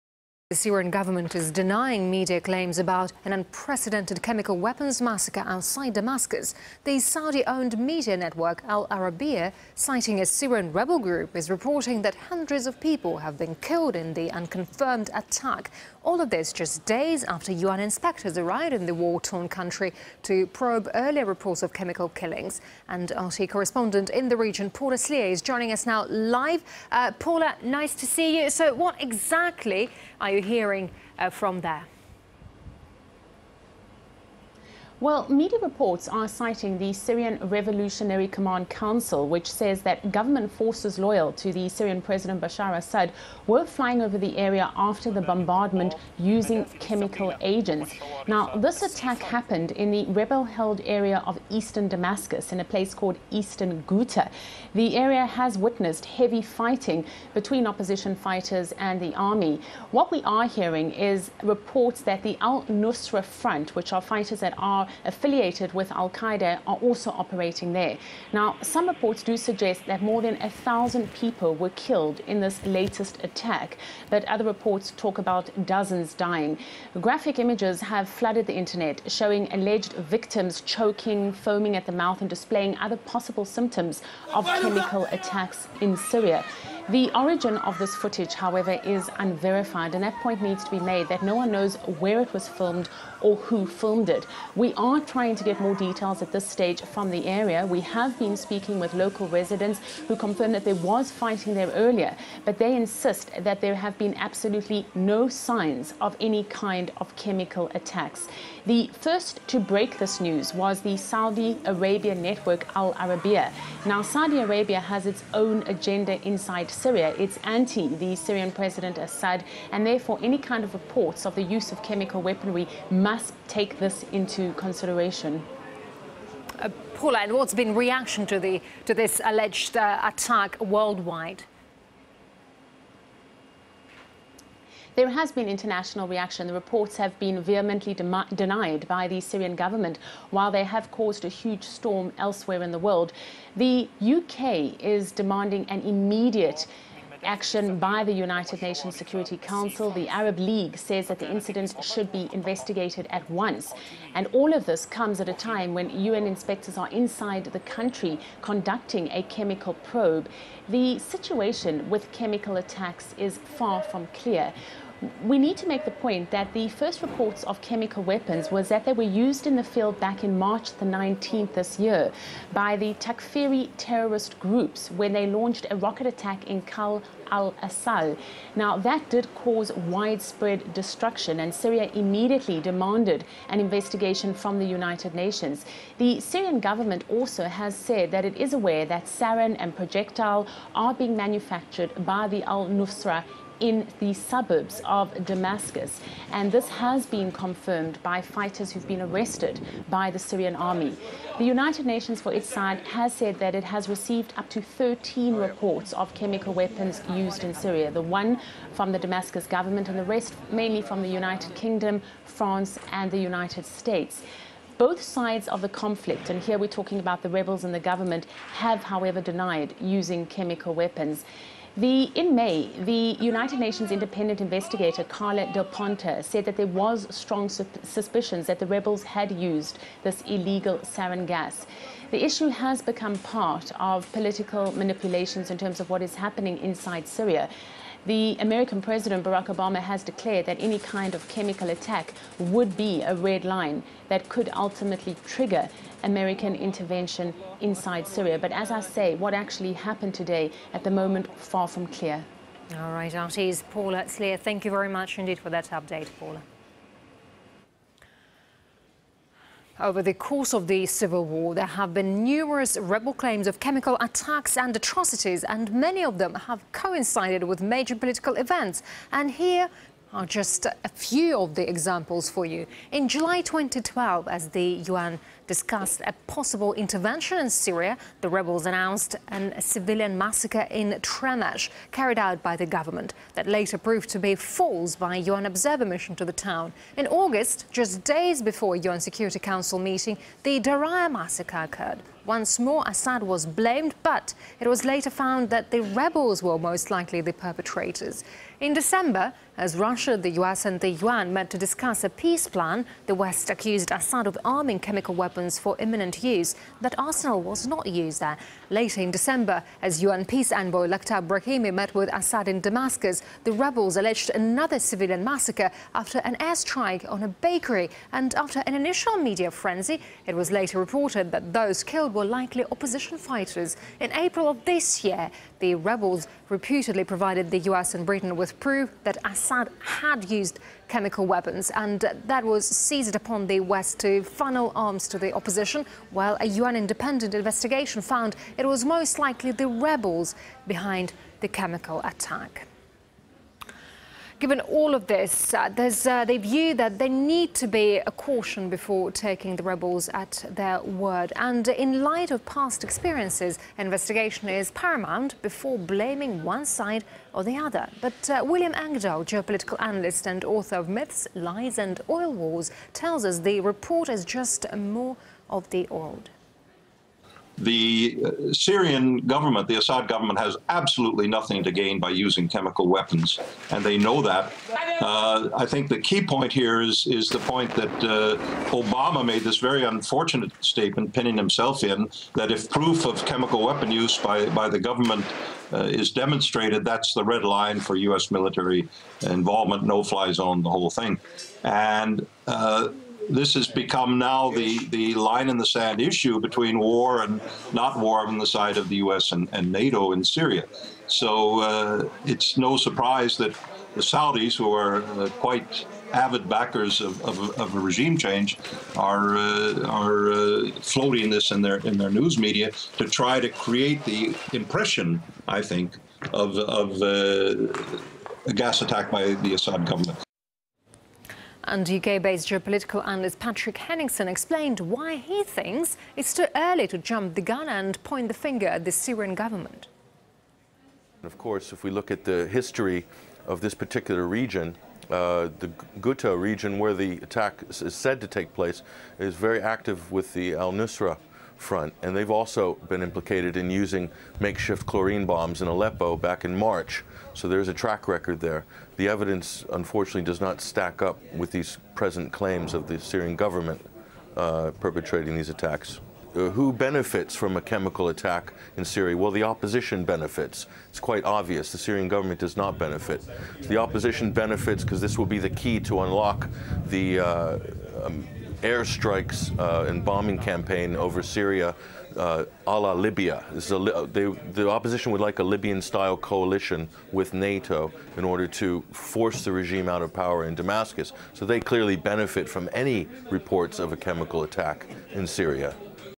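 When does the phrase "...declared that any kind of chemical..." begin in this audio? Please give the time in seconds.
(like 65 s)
240 s.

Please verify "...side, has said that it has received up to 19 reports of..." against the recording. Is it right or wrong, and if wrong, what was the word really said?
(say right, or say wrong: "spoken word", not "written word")
wrong: "13", not "19".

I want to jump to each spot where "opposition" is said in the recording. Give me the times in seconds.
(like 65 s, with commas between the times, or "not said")
57 s, 322 s, 335 s, 459 s, 463 s, 474 s.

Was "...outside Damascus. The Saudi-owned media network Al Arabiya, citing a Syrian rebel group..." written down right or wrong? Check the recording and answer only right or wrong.
right.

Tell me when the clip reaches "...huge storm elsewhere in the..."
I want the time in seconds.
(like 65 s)
141 s.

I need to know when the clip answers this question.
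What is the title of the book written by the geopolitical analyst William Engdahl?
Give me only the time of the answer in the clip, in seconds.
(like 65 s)
360 s.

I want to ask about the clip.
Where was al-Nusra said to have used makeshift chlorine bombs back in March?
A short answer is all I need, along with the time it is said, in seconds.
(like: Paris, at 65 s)
Aleppo, at 445 s.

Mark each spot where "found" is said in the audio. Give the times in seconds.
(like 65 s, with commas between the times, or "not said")
295 s, 338 s.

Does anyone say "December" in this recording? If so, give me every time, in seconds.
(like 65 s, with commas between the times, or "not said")
298 s, 309 s.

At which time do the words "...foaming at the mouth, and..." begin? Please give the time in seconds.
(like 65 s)
81 s.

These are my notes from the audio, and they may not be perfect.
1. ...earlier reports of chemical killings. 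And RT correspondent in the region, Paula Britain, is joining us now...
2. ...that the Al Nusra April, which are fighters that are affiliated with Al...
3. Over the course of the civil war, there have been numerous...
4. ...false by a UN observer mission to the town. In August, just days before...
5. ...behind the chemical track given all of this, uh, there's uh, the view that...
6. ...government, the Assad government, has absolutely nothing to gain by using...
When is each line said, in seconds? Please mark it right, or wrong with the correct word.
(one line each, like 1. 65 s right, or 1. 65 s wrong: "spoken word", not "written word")
1. 20 s wrong: "Slier", not "Britain"
2. 62 s wrong: "Front", not "April"
3. 259 s right
4. 284 s right
5. 340 s wrong: "attack", not "track"
6. 369 s right.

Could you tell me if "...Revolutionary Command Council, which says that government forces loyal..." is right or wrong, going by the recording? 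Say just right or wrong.
right.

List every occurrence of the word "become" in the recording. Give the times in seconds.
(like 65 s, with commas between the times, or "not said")
232 s, 393 s.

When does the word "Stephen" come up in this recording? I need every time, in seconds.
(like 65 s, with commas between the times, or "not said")
not said.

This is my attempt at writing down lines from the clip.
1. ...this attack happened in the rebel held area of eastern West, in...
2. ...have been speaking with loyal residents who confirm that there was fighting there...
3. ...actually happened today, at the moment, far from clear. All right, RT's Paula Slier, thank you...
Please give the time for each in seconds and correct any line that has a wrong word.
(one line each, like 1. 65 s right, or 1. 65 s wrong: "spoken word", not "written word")
1. 48 s wrong: "Damascus", not "West"
2. 97 s wrong: "local", not "loyal"
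3. 249 s right.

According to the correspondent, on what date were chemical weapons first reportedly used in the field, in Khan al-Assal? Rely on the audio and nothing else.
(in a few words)
March 19.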